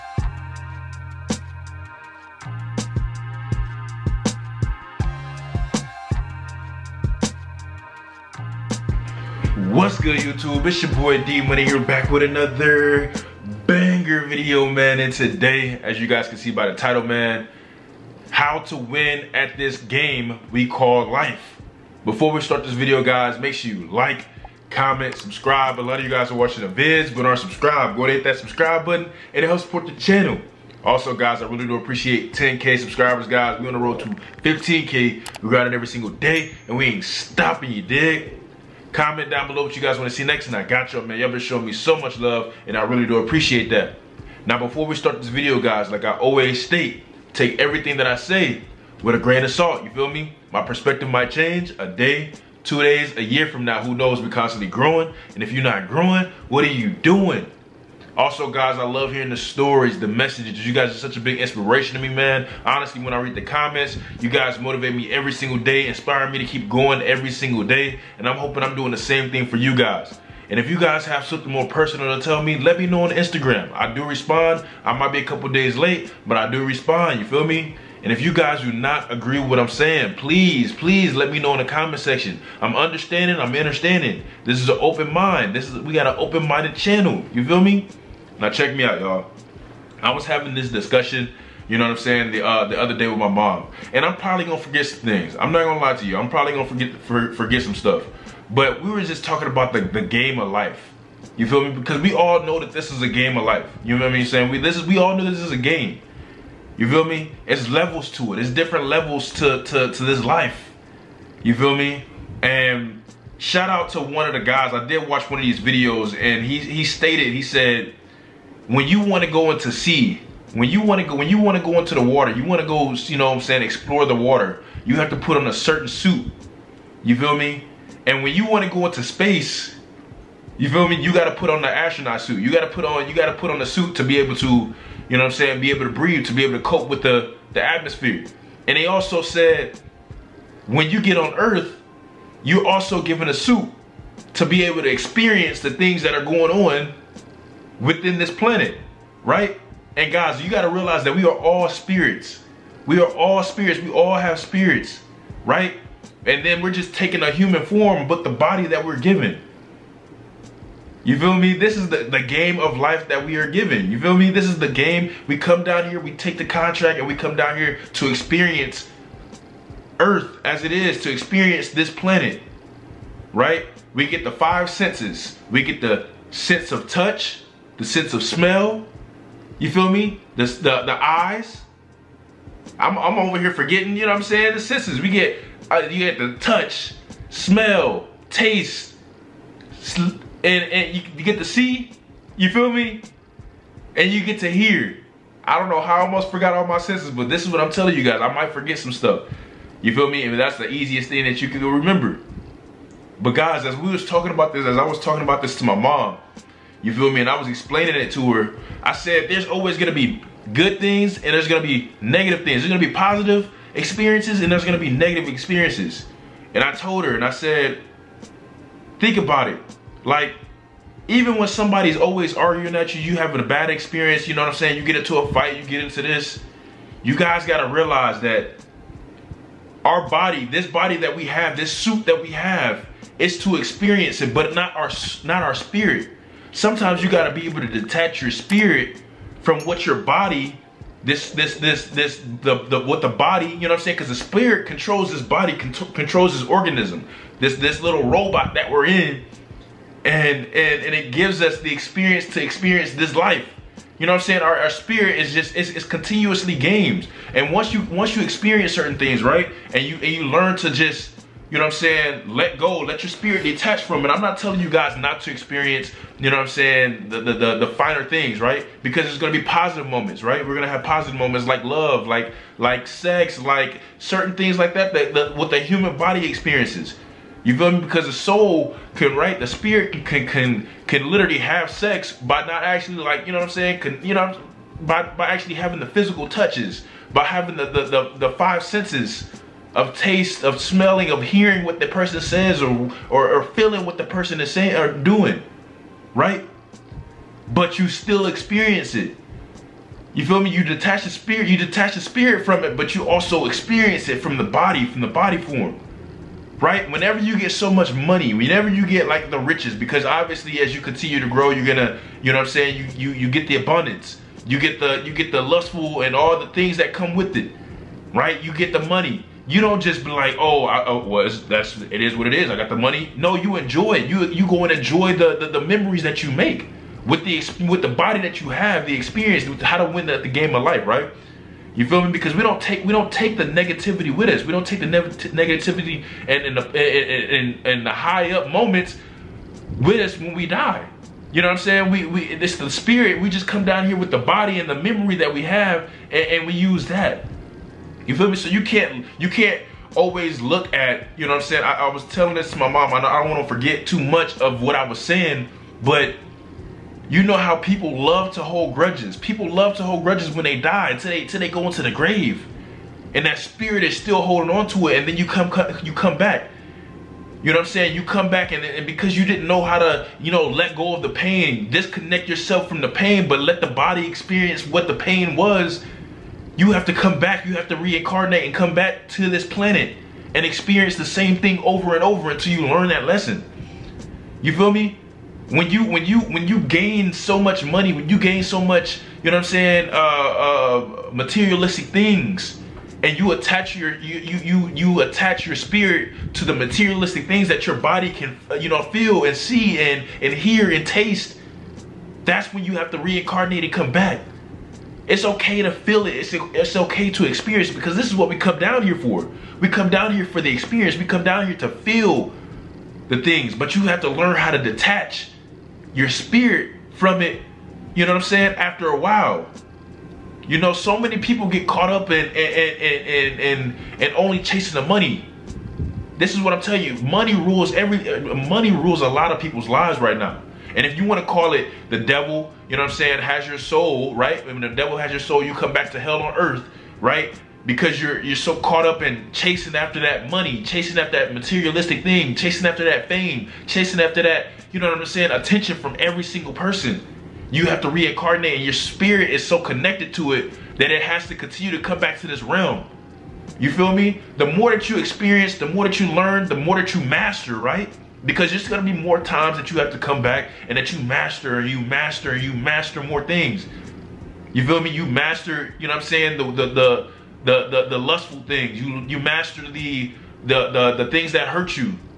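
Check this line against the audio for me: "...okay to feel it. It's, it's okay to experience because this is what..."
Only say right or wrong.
right.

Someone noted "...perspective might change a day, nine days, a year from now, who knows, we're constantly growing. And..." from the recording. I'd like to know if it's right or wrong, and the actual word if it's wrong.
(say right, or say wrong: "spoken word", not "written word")
wrong: "two", not "nine".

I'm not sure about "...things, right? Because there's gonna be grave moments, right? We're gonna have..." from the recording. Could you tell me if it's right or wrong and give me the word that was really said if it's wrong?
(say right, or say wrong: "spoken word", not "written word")
wrong: "positive", not "grave".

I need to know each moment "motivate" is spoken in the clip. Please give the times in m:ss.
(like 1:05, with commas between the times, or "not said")
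1:04.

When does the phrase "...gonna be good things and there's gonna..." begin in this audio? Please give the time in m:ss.
3:29.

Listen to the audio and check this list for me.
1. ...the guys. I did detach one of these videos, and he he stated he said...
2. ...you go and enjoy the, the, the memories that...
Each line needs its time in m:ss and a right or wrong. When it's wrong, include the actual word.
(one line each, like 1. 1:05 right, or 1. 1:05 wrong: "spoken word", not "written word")
1. 1:54 wrong: "watch", not "detach"
2. 5:24 right.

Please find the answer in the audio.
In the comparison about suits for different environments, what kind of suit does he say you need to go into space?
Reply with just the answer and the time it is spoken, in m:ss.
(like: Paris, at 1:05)
astronaut suit, at 2:11.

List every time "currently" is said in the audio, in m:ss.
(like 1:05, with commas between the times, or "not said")
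not said.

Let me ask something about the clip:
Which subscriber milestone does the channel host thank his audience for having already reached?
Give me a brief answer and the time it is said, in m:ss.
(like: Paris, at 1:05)
10K, at 0:32.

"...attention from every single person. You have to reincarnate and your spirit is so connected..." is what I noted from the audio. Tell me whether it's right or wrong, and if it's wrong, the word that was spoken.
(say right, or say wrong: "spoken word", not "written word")
right.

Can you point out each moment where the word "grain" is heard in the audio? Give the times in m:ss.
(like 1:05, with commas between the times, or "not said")
0:49.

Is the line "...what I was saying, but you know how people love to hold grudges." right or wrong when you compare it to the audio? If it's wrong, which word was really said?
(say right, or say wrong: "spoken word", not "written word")
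right.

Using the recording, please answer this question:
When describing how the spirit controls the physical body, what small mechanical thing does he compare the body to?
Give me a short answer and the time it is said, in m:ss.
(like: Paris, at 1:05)
little robot, at 4:07.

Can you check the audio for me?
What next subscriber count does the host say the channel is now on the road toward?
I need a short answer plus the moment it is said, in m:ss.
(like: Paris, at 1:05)
15K, at 0:34.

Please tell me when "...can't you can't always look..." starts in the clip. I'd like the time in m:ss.
5:48.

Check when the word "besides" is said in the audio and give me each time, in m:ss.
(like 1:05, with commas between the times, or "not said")
not said.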